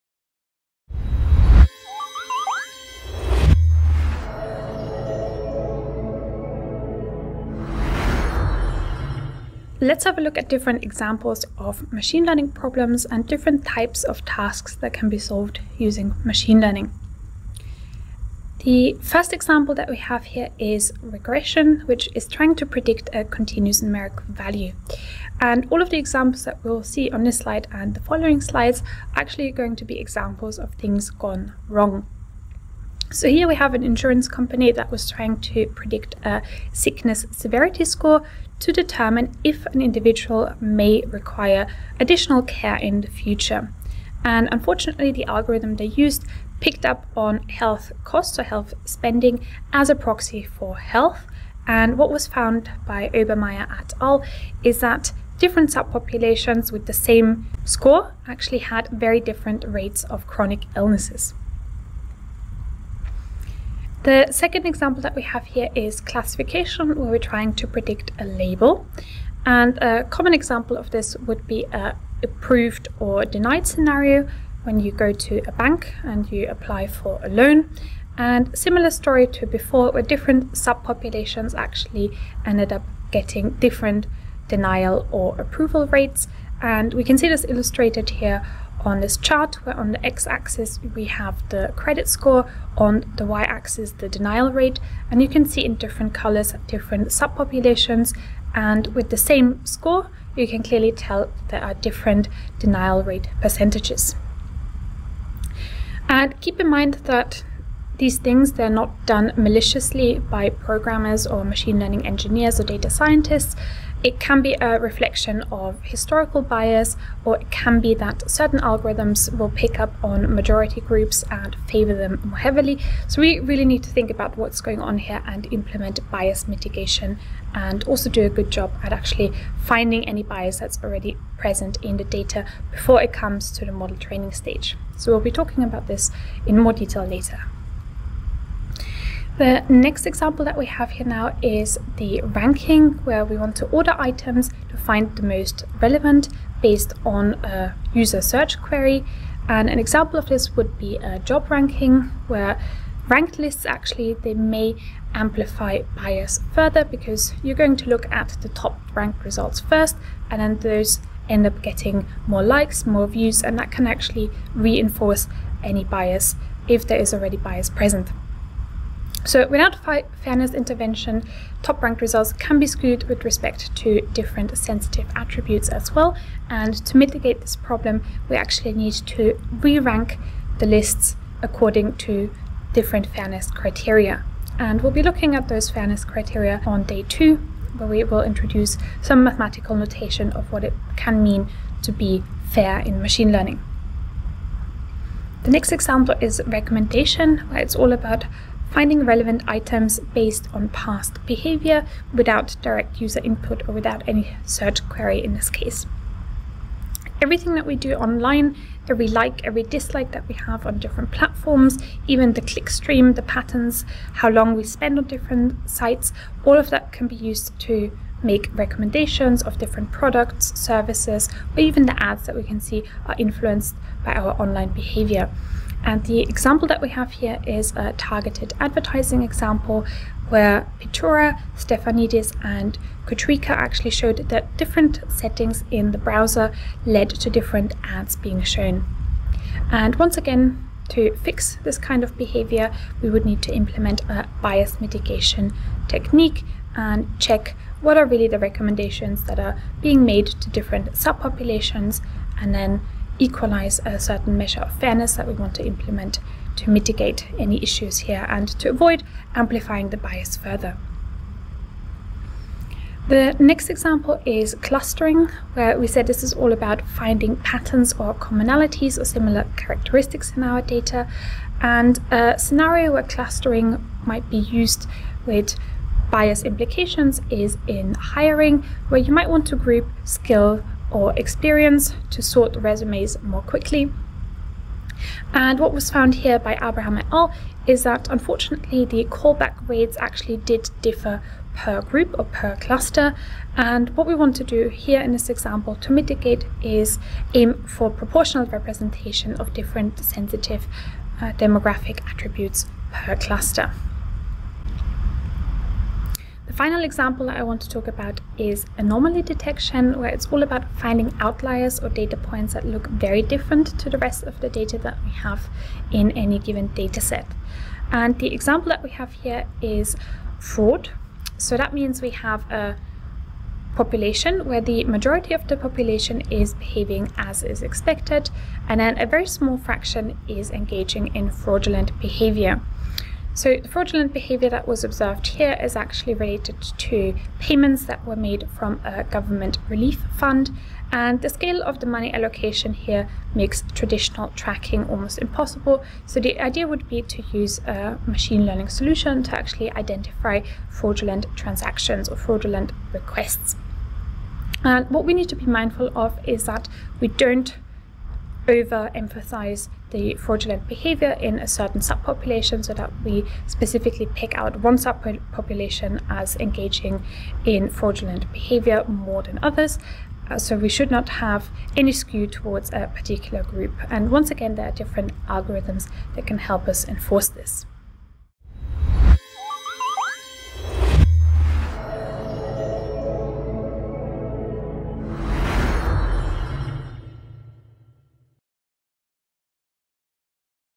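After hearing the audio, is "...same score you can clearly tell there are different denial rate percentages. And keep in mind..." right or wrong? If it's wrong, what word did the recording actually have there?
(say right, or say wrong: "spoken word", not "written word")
right.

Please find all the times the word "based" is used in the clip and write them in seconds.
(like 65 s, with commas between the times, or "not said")
146 s, 200 s.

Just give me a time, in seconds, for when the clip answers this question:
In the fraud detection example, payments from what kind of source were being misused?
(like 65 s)
339 s.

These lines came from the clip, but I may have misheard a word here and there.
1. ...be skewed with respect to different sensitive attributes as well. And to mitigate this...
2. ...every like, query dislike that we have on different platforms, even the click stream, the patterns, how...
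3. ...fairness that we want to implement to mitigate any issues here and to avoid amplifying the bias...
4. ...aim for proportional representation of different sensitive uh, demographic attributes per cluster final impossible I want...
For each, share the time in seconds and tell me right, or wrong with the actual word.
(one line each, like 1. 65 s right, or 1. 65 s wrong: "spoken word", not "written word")
1. 172 s right
2. 208 s wrong: "every", not "query"
3. 254 s right
4. 297 s wrong: "example", not "impossible".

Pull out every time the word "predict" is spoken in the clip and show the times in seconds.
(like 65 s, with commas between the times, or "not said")
22 s, 35 s, 67 s.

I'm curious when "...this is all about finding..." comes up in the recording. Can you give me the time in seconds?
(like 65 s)
266 s.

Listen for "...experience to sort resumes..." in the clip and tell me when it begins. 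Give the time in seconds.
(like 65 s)
281 s.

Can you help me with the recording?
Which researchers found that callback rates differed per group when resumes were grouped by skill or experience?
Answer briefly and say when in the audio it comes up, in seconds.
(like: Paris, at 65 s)
Abraham et al., at 286 s.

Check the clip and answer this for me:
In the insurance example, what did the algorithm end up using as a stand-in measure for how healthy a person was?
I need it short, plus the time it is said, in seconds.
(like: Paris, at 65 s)
health spending, at 48 s.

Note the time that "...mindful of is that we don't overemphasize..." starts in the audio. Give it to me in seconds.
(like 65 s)
355 s.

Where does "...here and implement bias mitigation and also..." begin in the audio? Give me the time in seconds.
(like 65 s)
124 s.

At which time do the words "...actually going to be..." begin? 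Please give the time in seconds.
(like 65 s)
29 s.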